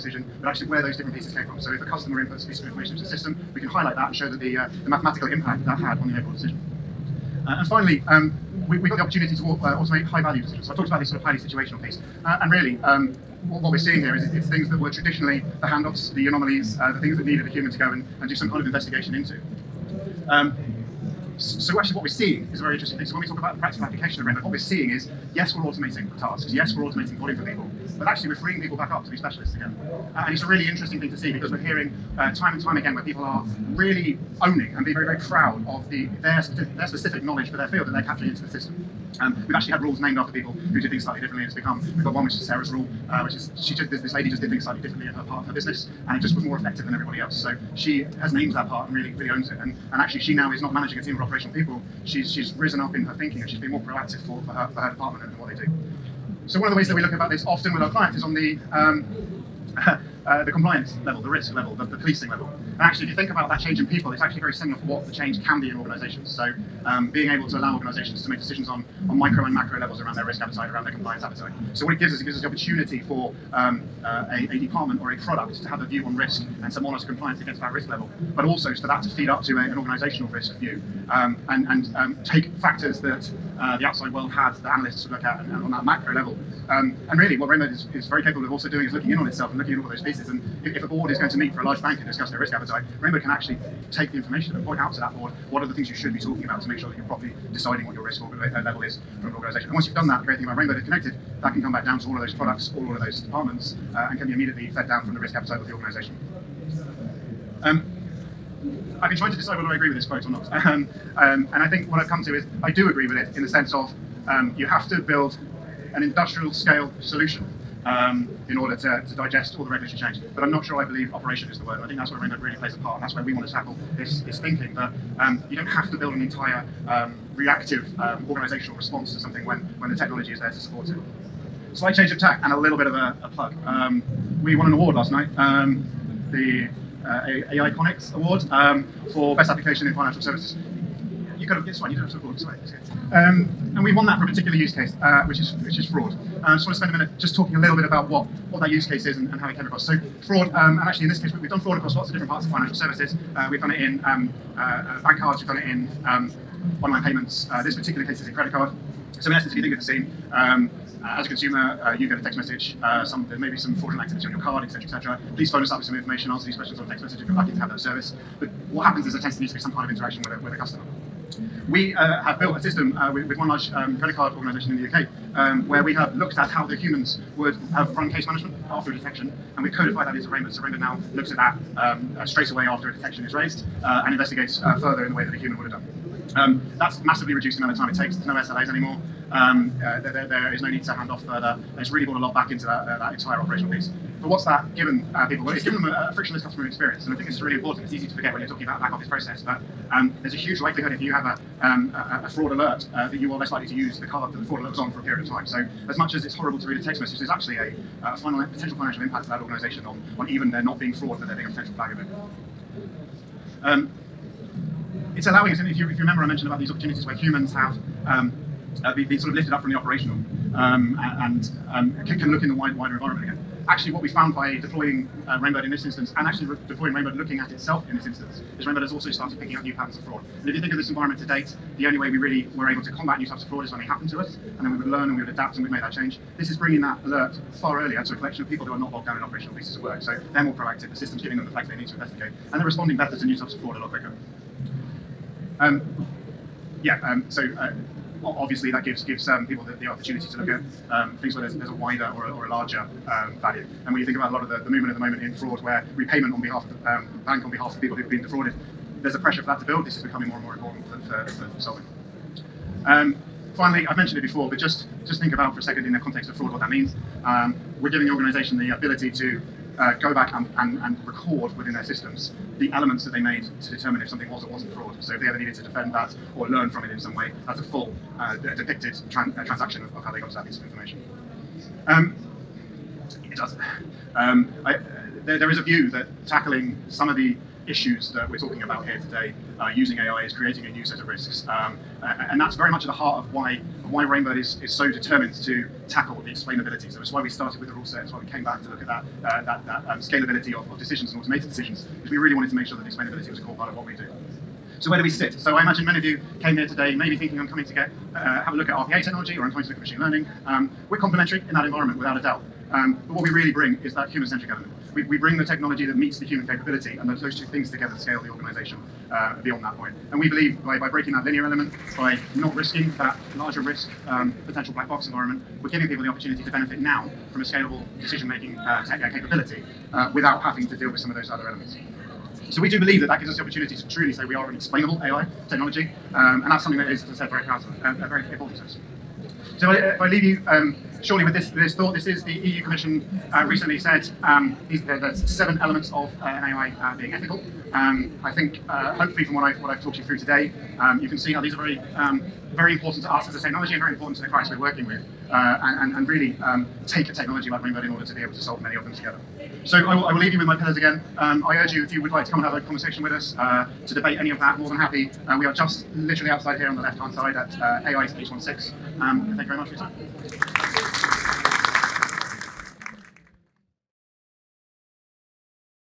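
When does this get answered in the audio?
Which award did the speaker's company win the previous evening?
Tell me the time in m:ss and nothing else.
2:17.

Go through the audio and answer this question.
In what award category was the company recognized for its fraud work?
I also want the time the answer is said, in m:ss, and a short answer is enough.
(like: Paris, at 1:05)
Best Application in Financial Services, at 2:19.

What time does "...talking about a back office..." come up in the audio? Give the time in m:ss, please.
3:18.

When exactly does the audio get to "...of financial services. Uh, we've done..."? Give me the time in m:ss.
2:32.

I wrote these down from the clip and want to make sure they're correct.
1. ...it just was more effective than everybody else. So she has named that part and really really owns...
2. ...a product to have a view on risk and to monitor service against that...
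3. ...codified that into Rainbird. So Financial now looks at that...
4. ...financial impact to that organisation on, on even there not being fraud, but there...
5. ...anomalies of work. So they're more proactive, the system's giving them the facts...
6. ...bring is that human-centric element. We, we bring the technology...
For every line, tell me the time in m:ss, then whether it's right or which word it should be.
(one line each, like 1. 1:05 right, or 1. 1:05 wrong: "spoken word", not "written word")
1. 0:46 right
2. 1:15 wrong: "compliance", not "service"
3. 2:59 wrong: "Rainbird", not "Financial"
4. 3:28 right
5. 3:59 wrong: "pieces", not "anomalies"
6. 5:13 right.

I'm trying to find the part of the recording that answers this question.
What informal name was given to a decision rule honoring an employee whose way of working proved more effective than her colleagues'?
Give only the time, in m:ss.
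0:42.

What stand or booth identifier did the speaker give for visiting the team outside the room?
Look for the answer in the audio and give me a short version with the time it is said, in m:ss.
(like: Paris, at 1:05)
AI's 16, at 6:07.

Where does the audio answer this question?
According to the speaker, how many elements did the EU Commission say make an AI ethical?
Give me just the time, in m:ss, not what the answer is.
5:45.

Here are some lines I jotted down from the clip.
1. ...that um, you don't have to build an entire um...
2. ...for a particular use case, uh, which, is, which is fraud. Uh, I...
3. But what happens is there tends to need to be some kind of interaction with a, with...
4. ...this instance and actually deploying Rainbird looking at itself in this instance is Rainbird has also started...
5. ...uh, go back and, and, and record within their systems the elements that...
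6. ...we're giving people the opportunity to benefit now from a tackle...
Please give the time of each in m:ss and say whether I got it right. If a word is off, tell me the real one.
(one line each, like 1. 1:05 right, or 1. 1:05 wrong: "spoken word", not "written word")
1. 2:04 right
2. 2:24 right
3. 2:48 right
4. 3:45 right
5. 4:29 right
6. 5:25 wrong: "scalable", not "tackle".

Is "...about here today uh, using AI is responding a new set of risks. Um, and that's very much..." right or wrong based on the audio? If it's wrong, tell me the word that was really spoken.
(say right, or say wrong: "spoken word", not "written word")
wrong: "creating", not "responding".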